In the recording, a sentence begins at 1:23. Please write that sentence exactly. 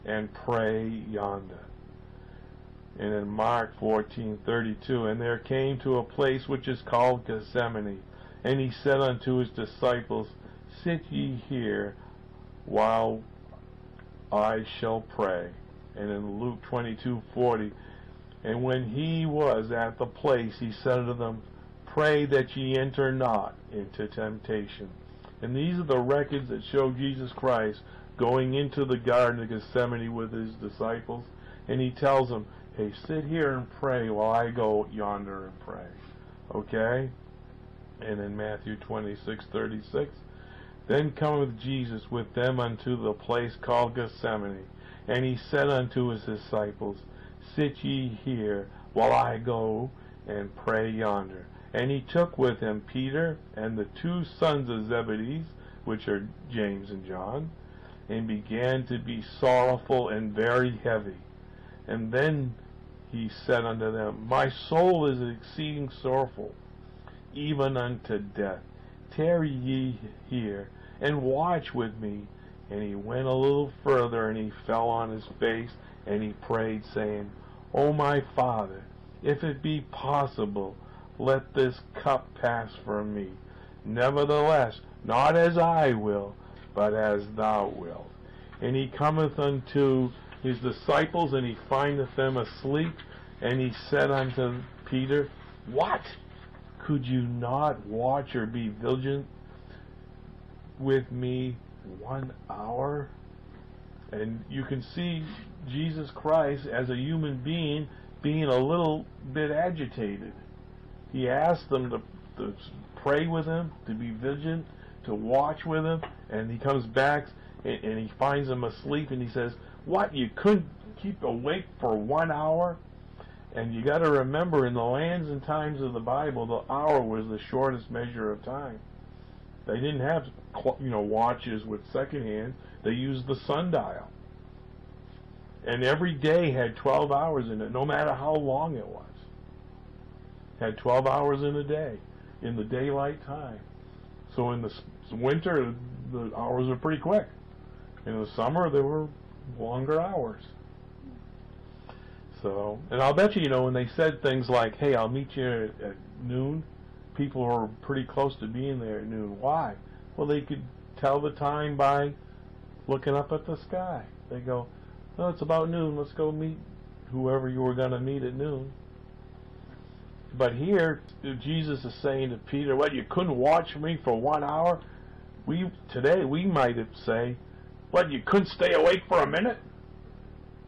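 Nevertheless, not as I will, but as thou wilt.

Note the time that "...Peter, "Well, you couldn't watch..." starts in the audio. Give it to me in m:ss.
2:52.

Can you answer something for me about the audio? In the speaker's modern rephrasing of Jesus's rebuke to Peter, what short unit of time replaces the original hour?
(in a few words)
A minute.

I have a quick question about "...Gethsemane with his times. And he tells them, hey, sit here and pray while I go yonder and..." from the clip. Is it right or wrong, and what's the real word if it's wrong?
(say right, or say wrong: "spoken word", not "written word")
wrong: "disciples", not "times".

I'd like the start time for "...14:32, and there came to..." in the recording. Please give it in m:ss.
0:03.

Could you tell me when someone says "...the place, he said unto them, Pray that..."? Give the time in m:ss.
0:19.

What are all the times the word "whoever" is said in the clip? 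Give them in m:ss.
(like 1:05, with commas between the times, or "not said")
2:47.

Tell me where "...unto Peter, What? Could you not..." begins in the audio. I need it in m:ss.
1:34.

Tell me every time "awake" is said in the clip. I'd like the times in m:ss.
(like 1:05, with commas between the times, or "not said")
2:01, 2:58.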